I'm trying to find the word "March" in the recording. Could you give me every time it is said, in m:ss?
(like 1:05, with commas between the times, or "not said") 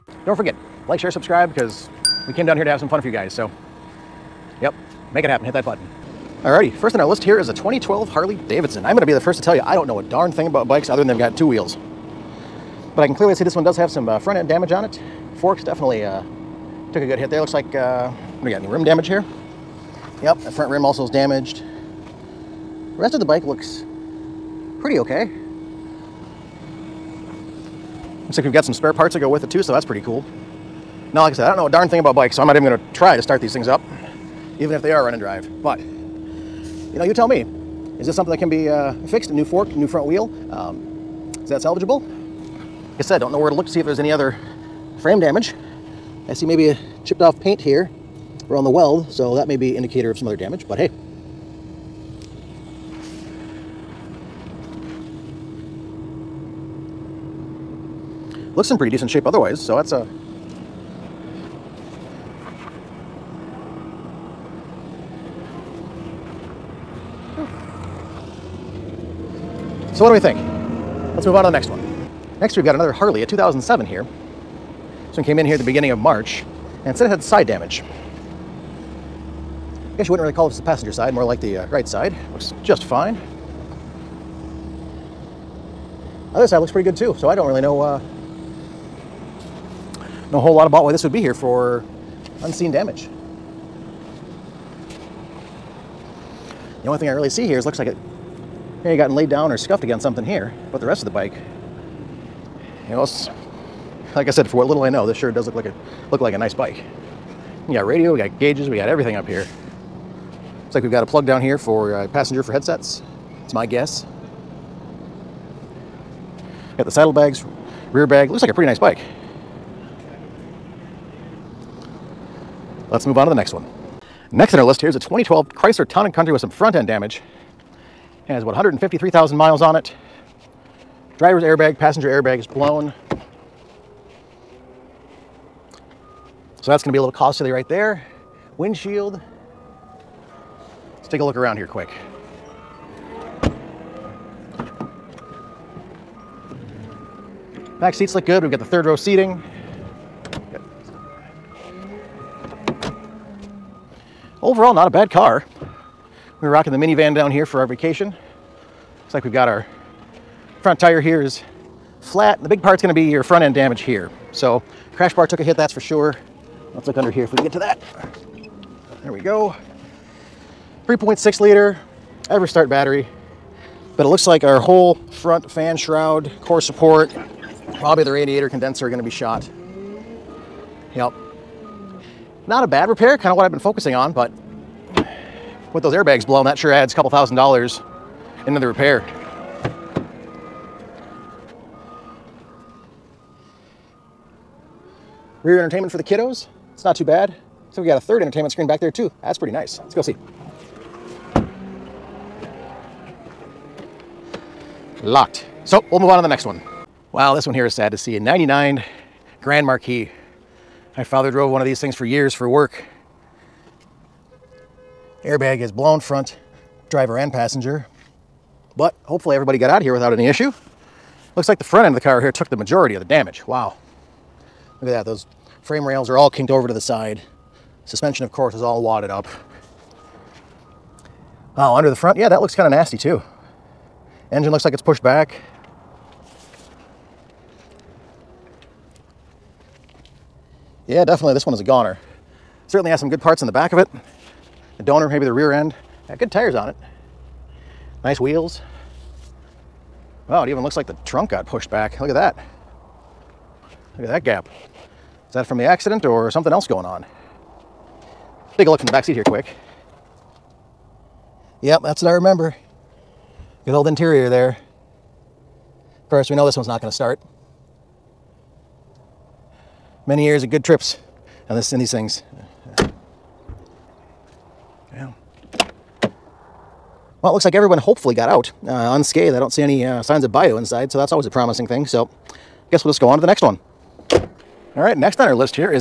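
1:15.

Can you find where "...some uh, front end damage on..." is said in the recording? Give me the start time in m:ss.
0:13.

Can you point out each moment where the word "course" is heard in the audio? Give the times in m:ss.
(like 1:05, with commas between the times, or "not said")
3:48, 4:26.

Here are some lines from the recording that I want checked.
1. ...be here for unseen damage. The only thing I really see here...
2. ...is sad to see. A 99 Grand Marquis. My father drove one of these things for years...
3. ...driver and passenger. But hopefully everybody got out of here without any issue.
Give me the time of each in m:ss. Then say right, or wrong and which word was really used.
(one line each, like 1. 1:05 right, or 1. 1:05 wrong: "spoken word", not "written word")
1. 1:31 right
2. 3:27 right
3. 3:36 right.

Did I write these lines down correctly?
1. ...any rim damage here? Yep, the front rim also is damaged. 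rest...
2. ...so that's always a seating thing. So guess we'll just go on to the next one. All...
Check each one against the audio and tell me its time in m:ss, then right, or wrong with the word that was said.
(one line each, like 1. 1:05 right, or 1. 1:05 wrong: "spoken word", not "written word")
1. 0:18 right
2. 4:40 wrong: "promising", not "seating".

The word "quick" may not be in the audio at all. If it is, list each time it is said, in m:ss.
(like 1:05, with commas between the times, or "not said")
2:21, 4:19.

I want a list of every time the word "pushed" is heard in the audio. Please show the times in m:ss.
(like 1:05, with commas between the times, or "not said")
3:54, 4:11.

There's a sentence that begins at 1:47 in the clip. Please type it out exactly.
We got radio, we got gauges, we got everything up here.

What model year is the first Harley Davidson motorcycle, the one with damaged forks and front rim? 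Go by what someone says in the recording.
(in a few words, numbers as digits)
2012.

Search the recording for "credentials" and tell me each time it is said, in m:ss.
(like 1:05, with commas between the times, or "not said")
not said.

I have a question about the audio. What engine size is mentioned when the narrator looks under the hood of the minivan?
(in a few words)
3.6 liter.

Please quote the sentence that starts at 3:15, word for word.
Rear entertainment for the kiddos not too bad.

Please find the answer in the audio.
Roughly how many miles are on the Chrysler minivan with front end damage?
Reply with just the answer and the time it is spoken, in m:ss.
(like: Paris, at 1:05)
153,000, at 2:08.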